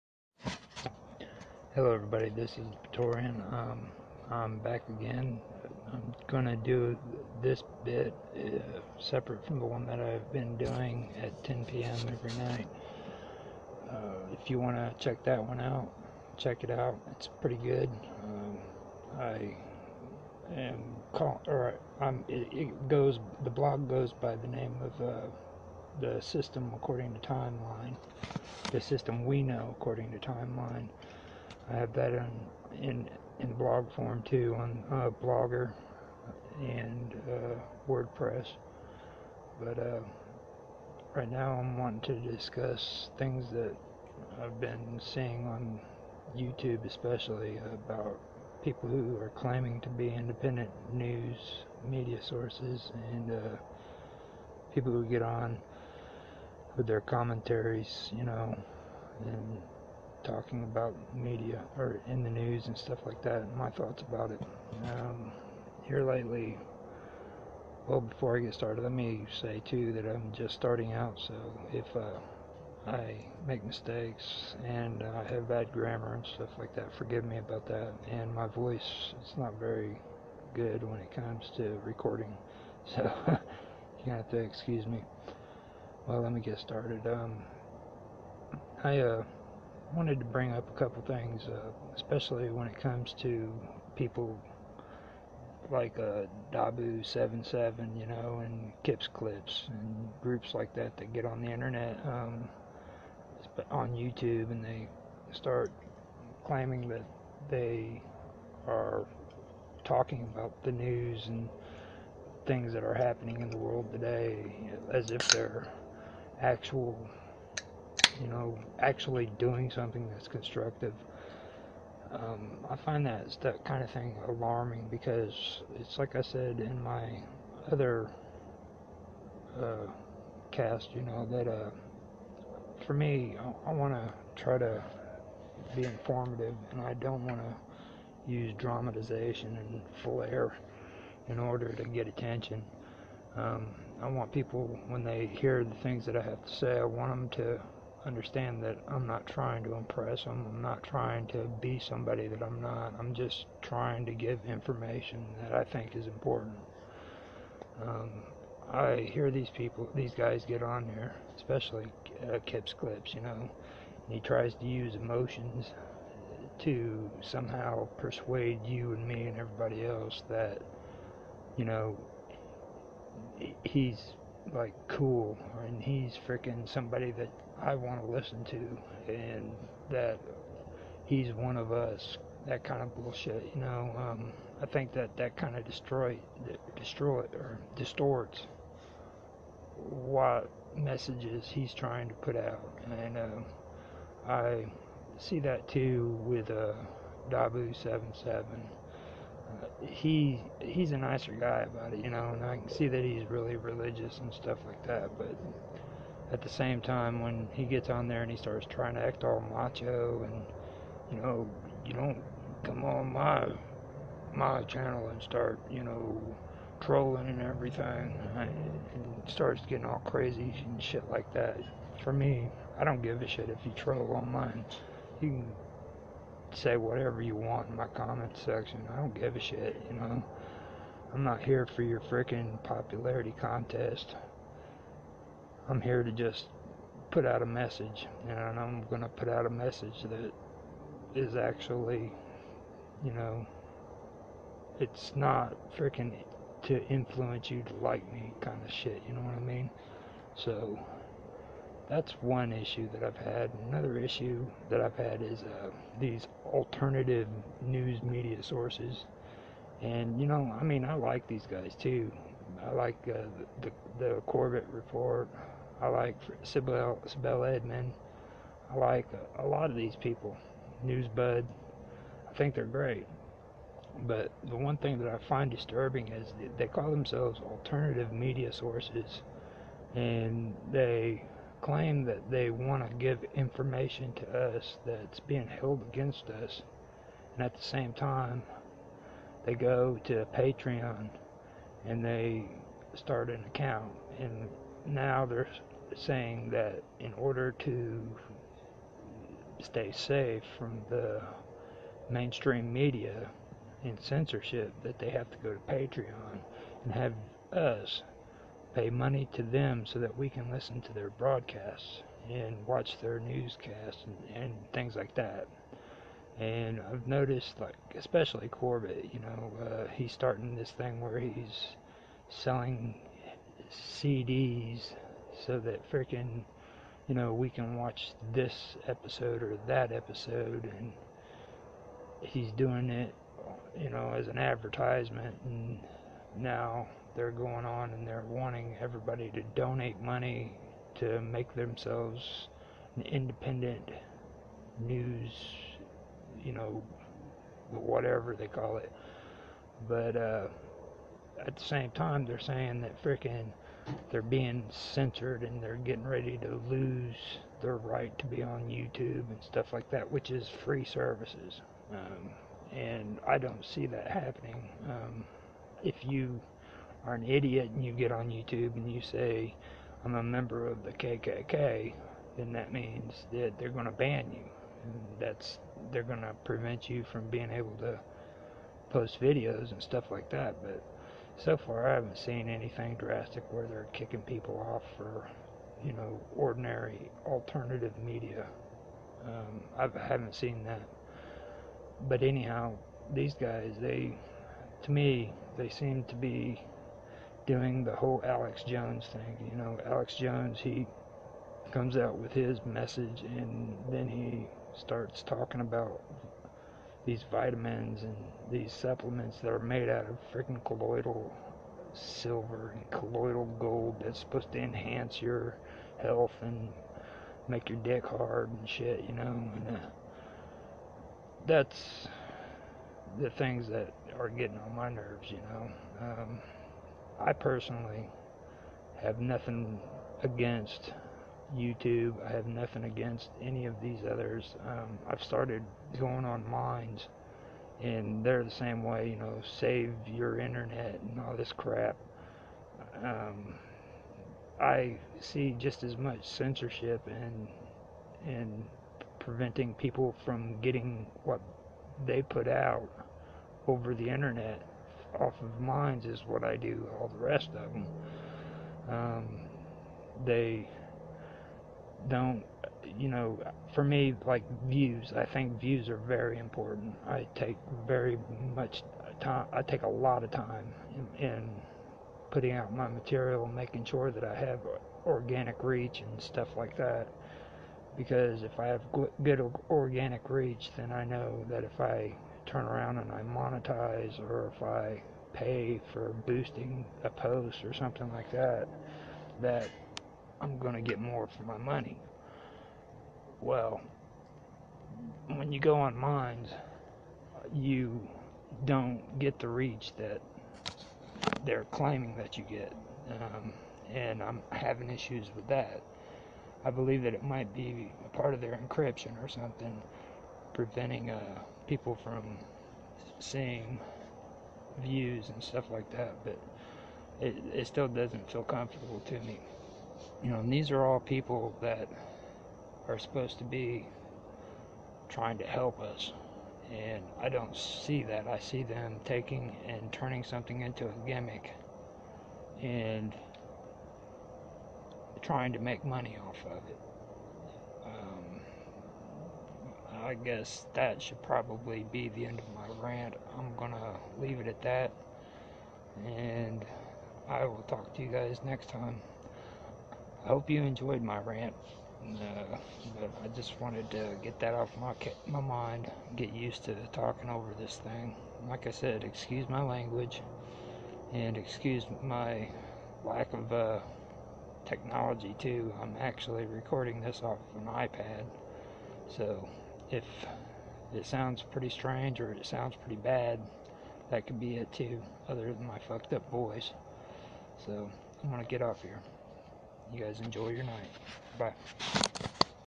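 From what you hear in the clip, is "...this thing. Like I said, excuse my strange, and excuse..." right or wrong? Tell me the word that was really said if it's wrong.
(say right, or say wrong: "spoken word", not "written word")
wrong: "language", not "strange".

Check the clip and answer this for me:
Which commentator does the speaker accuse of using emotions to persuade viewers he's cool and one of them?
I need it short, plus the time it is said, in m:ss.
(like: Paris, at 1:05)
Kip's Clips, at 2:42.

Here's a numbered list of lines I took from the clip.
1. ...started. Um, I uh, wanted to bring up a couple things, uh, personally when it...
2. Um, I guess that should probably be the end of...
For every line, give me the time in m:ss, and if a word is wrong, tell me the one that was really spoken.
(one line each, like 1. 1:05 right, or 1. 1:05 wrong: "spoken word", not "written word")
1. 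1:26 wrong: "especially", not "personally"
2. 8:57 right.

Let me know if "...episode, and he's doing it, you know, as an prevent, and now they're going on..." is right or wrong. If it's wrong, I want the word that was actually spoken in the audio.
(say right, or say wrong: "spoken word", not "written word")
wrong: "advertisement", not "prevent".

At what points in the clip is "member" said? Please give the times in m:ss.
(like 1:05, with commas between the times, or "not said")
6:10.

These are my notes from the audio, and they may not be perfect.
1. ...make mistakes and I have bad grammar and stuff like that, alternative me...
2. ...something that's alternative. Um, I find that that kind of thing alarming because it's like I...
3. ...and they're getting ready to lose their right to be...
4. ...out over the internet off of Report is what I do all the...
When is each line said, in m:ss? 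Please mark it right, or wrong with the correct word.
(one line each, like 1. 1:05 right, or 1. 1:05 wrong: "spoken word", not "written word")
1. 1:13 wrong: "forgive", not "alternative"
2. 1:59 wrong: "constructive", not "alternative"
3. 5:55 right
4. 7:32 wrong: "Minds", not "Report".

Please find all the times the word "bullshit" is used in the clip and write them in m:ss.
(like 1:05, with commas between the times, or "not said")
3:02.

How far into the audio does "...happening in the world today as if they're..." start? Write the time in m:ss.
1:52.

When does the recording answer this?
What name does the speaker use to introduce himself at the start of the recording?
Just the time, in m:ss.
0:02.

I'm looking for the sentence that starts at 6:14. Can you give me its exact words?
And that's they're going to prevent you from being able to post videos and stuff like that.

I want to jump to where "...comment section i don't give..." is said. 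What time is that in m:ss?
3:47.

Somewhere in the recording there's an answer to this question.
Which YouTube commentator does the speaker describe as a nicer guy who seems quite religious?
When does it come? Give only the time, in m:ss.
3:17.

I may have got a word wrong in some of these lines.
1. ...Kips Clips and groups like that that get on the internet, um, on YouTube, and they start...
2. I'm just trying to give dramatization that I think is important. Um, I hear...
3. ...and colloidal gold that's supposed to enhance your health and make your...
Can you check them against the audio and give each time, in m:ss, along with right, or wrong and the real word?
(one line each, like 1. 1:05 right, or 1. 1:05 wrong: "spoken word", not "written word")
1. 1:38 right
2. 2:32 wrong: "information", not "dramatization"
3. 6:52 right.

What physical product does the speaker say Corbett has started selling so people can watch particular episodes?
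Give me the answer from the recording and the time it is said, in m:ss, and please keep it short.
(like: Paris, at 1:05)
CDs, at 5:23.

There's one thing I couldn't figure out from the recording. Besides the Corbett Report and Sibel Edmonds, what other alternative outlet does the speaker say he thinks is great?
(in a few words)
Newsbud.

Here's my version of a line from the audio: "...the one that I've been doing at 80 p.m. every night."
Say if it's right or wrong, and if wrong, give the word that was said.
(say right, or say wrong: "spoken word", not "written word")
wrong: "10", not "80".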